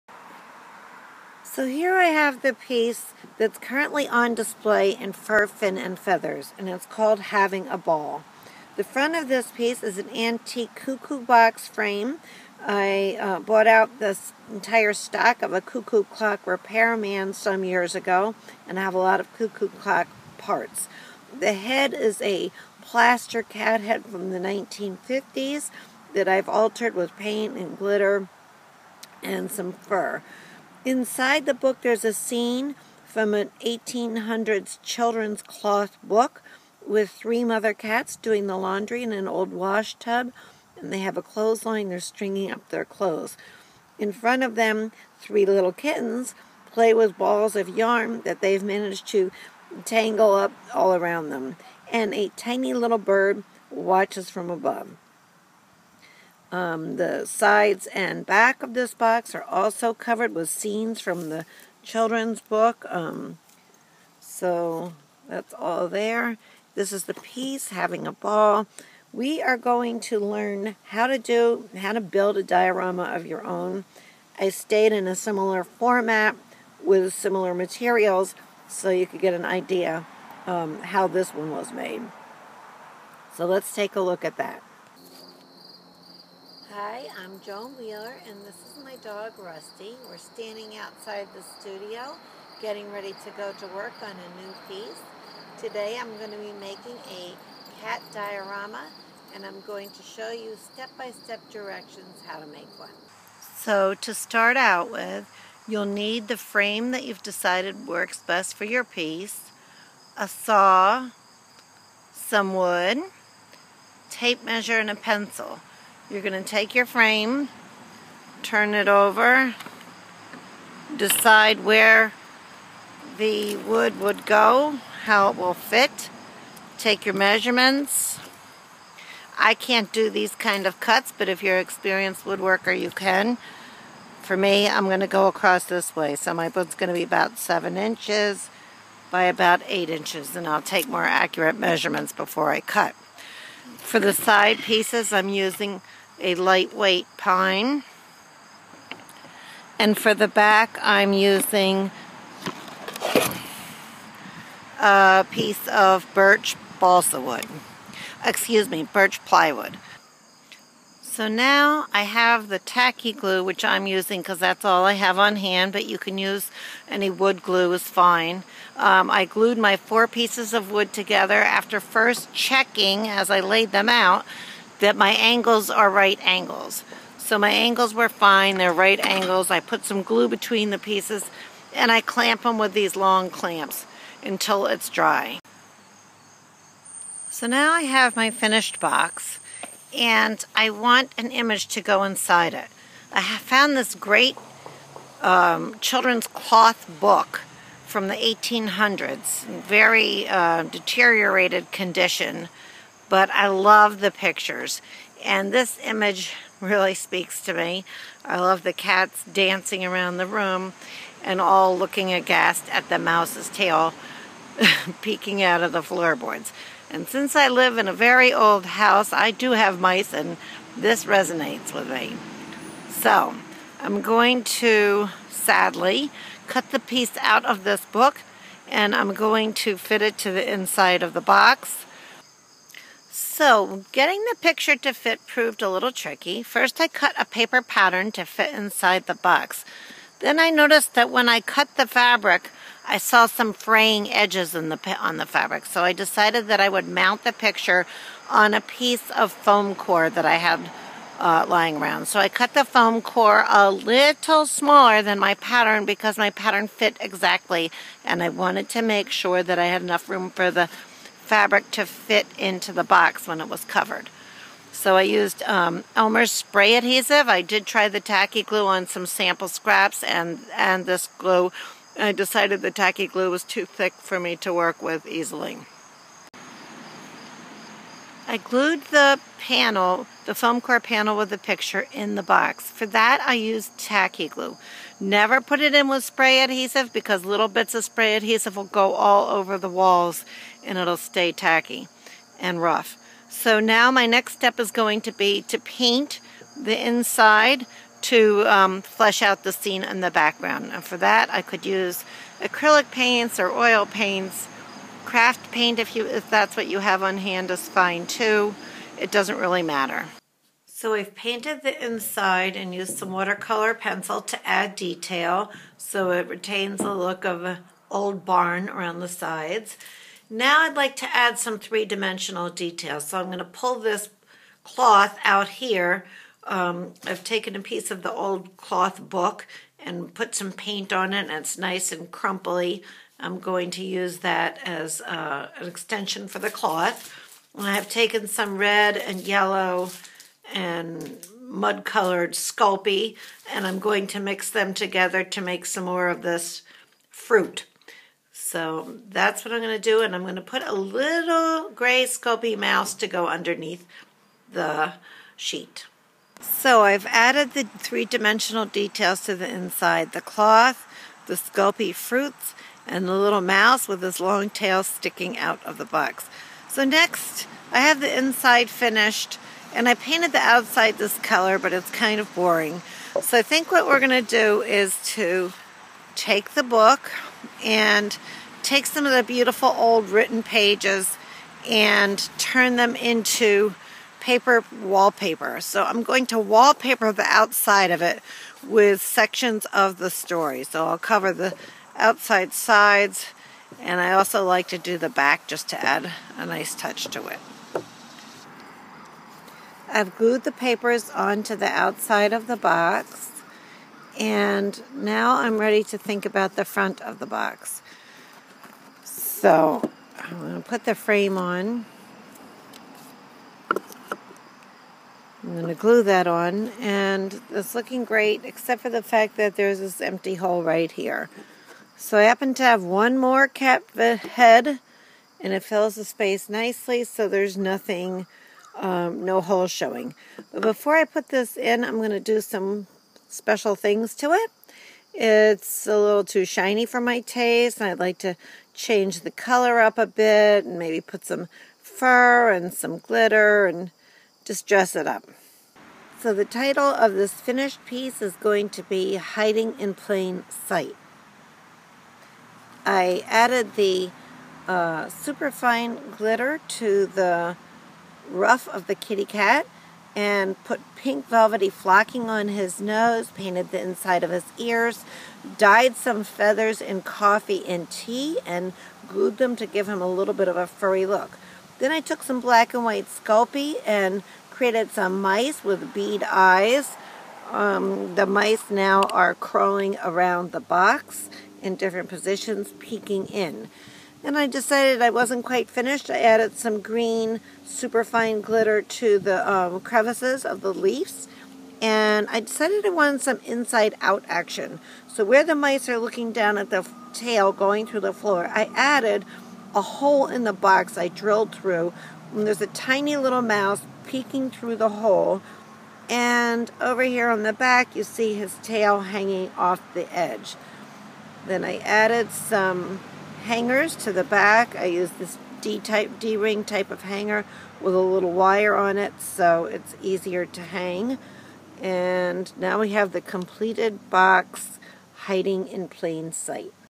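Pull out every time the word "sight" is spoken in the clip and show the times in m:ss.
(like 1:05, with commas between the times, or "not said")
7:30, 8:46.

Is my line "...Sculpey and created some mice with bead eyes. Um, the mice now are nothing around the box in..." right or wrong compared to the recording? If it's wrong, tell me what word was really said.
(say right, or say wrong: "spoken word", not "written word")
wrong: "crawling", not "nothing".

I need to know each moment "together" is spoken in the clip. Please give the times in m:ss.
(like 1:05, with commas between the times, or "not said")
2:50, 5:44.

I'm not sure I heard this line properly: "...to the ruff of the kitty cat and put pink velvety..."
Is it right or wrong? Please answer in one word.
right.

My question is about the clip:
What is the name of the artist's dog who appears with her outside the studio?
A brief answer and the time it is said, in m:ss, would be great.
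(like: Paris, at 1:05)
Rusty, at 1:29.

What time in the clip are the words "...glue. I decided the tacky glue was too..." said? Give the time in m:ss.
4:31.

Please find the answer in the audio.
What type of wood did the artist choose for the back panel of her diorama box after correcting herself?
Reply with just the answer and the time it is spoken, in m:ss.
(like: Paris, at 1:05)
Birch plywood, at 2:38.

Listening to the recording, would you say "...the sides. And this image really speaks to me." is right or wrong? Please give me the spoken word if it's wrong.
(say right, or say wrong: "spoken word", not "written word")
wrong: "pictures", not "sides".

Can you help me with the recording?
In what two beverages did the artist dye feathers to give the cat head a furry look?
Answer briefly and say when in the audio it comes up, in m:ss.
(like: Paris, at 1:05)
Coffee and tea, at 7:47.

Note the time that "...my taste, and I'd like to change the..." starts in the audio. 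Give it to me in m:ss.
7:17.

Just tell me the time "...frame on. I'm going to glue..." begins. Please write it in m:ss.
6:50.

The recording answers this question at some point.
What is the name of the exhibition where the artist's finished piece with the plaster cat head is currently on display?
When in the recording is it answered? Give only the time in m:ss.
0:05.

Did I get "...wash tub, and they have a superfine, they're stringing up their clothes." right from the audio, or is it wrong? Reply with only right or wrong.
wrong.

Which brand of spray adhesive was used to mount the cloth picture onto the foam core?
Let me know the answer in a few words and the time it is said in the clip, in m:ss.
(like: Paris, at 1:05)
Elmer's, at 4:25.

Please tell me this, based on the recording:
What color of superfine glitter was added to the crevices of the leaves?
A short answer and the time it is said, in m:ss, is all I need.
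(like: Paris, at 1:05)
Green, at 8:06.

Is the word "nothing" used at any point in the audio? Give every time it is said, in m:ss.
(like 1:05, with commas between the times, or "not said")
7:07.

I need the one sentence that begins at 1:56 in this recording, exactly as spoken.
You're going to take your frame, turn it over, decide where the wood would go, how it will fit, take your measurements.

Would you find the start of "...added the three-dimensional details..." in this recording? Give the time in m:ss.
5:57.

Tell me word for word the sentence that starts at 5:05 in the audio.
Craft paint, if, you, if that's what you have on hand, is fine too.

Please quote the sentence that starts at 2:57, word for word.
So my angles were fine, they're right angles.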